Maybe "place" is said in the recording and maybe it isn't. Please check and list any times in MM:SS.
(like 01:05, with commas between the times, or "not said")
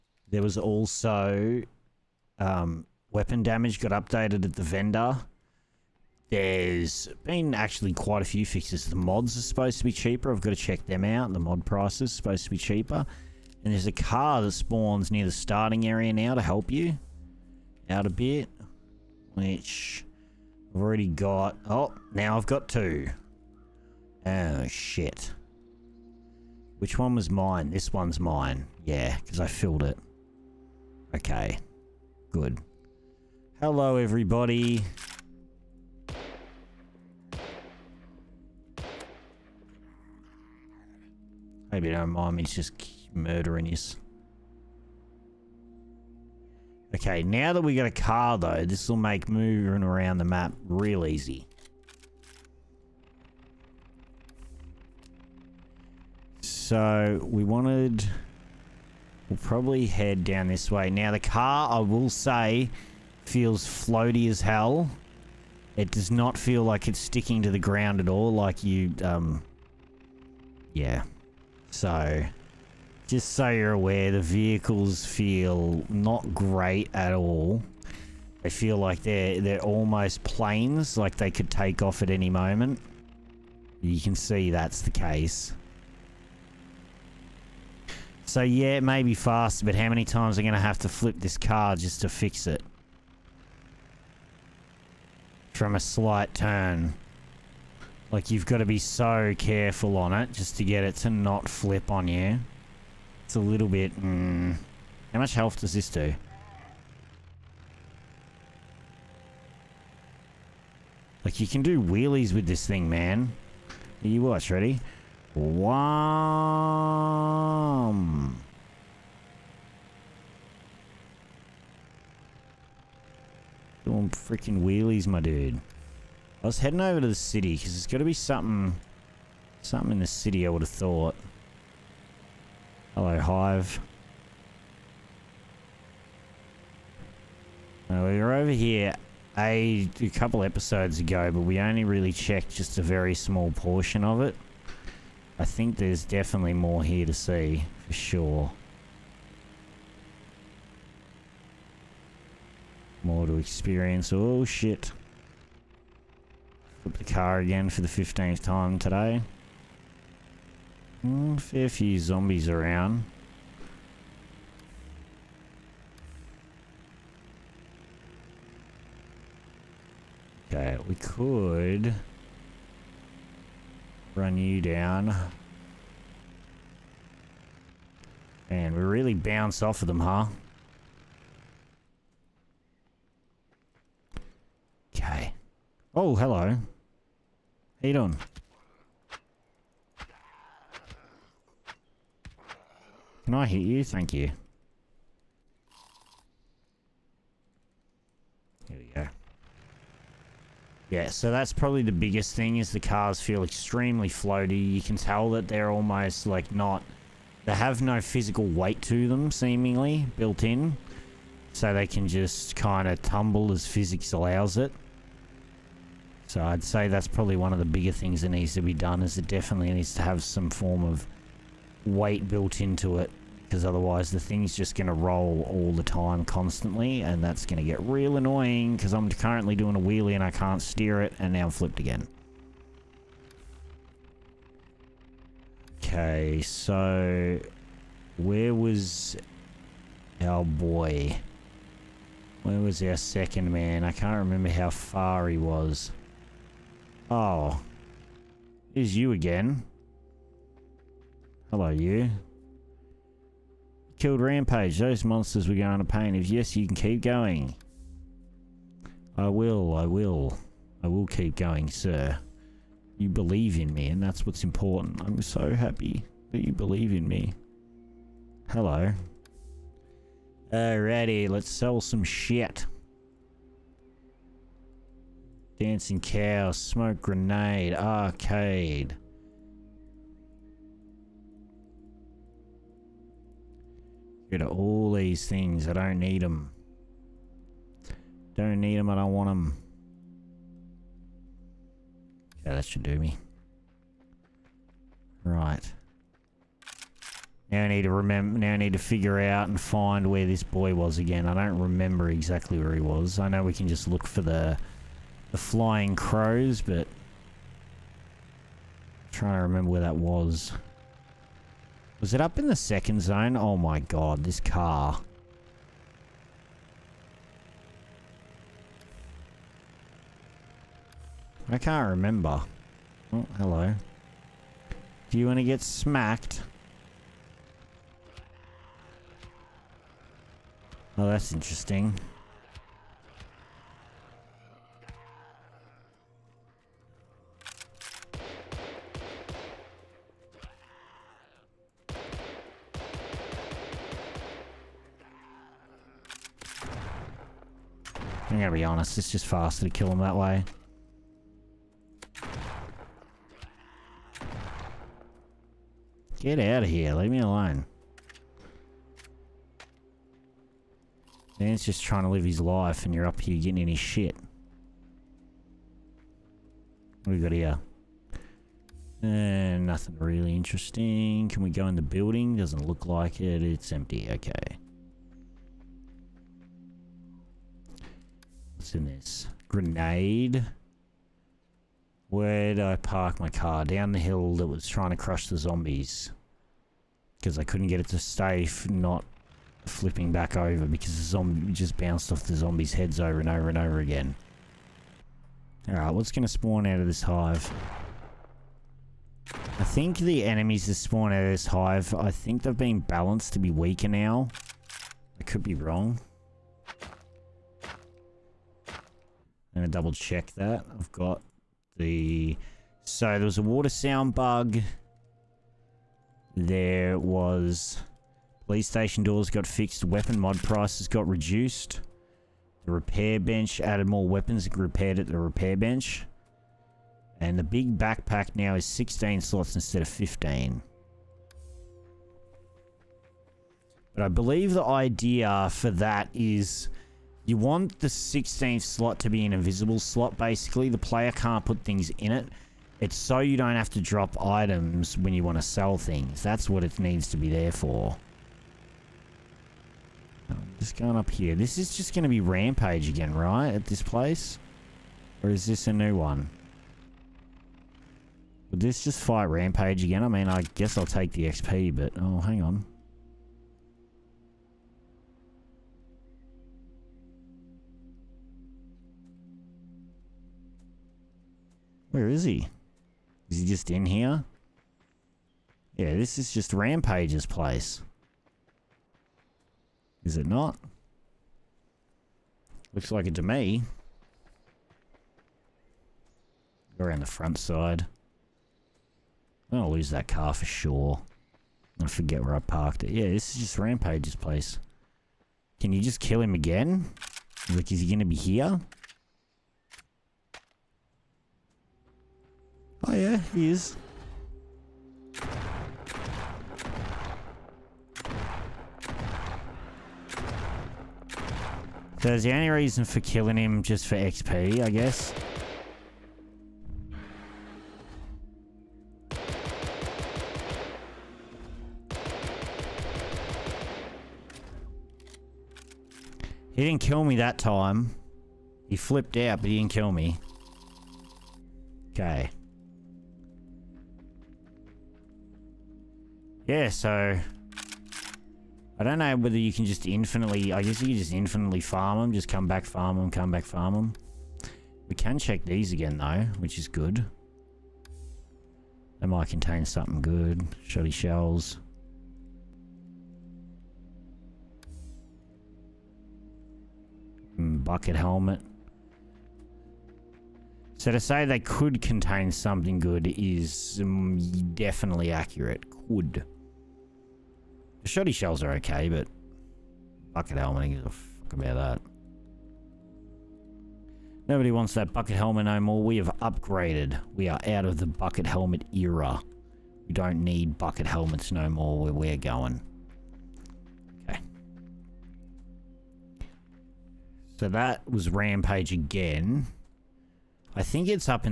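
07:33, 07:57, 08:14.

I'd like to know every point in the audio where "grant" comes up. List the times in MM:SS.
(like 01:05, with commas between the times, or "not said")
not said.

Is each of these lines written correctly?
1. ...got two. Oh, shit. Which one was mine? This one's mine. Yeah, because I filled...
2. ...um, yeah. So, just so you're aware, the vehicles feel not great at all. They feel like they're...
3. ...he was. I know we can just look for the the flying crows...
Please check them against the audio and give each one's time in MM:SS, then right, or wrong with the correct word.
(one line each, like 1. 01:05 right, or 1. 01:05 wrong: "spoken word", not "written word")
1. 00:22 right
2. 01:09 right
3. 05:02 right.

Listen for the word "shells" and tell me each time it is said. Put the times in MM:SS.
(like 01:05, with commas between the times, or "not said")
09:10, 09:28.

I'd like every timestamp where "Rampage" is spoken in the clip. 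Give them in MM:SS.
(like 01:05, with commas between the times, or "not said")
04:14, 07:32, 07:39, 07:56, 08:13, 09:48.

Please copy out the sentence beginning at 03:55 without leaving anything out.
Okay, so where was our boy?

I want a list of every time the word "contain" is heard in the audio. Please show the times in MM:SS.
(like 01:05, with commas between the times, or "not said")
09:09, 09:21.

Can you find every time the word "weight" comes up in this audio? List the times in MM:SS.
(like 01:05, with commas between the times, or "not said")
03:28, 03:41.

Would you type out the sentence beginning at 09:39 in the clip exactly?
We don't need bucket helmets no more where we're going.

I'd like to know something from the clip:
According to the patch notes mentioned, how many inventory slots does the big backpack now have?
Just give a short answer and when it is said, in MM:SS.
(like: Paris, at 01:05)
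16, at 07:08.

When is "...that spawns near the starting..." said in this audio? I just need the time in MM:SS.
00:14.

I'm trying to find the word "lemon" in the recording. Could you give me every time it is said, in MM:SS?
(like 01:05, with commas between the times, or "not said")
not said.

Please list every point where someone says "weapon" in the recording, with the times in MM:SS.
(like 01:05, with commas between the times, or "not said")
00:03, 06:59, 07:04.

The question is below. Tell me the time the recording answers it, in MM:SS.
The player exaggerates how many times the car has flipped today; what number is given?
02:37.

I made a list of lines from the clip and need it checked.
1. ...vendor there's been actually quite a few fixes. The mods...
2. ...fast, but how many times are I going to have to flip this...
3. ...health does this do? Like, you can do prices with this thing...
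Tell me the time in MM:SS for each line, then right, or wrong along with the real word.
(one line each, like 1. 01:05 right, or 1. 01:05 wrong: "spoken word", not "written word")
1. 00:04 right
2. 01:29 right
3. 01:45 wrong: "wheelies", not "prices".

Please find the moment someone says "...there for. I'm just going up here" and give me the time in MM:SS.
07:27.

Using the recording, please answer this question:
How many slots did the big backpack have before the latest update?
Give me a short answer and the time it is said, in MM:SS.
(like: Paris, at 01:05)
15, at 07:09.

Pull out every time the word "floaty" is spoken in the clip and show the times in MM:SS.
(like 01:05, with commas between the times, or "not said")
01:03, 03:24.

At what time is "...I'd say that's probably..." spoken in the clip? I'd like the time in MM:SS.
03:36.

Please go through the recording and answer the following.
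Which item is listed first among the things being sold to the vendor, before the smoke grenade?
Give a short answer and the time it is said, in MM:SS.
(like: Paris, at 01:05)
Dancing cow, at 04:35.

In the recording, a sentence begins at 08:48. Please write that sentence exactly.
He flipped out, but he didn't kill me.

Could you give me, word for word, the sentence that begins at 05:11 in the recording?
Was it up in the second zone?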